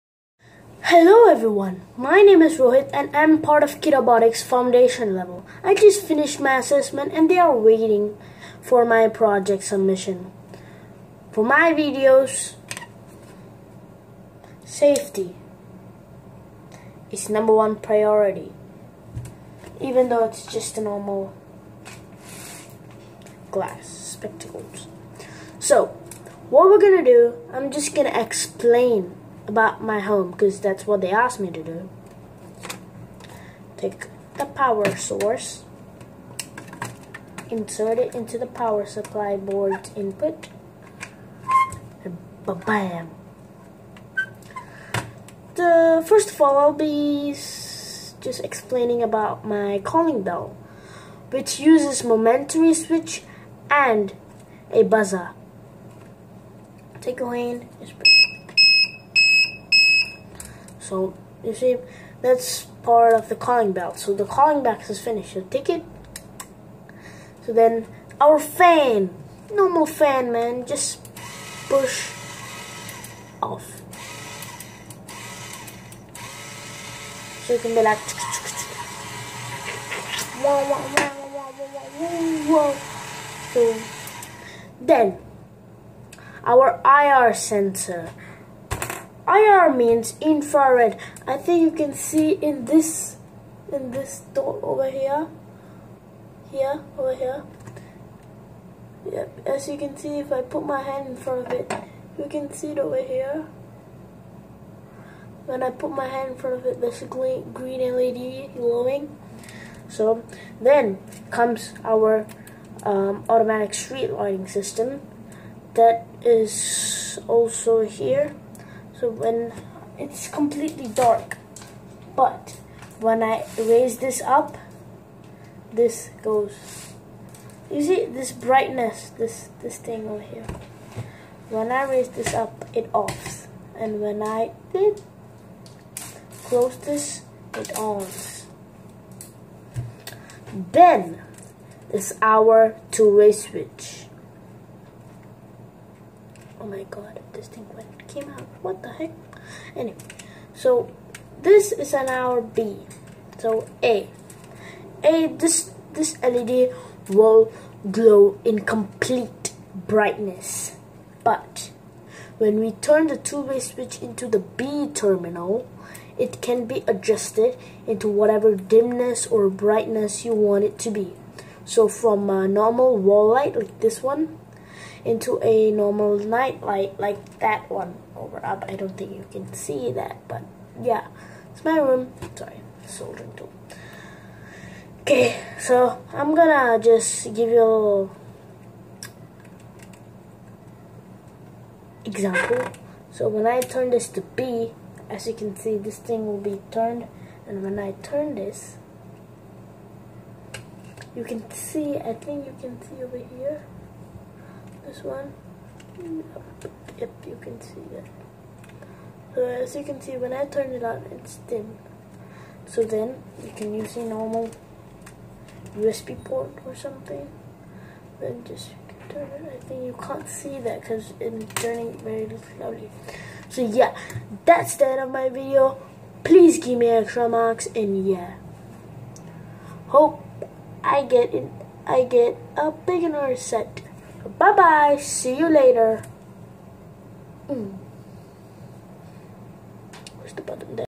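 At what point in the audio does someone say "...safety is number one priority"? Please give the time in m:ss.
0:14.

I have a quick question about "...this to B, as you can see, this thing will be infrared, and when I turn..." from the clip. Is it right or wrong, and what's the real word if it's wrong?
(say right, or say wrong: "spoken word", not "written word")
wrong: "turned", not "infrared".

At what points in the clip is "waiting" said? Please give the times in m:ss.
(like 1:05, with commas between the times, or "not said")
0:07.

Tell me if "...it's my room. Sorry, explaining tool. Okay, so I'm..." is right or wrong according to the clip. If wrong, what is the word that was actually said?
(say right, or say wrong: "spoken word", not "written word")
wrong: "soldering", not "explaining".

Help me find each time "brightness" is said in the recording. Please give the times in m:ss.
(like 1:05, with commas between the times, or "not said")
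2:08, 2:39, 2:49.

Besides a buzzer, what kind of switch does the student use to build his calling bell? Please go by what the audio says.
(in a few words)
momentary switch.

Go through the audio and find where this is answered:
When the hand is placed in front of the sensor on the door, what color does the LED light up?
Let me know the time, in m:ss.
1:47.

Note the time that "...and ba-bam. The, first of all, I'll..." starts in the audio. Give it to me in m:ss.
0:42.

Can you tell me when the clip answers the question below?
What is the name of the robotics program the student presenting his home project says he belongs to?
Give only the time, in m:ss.
0:03.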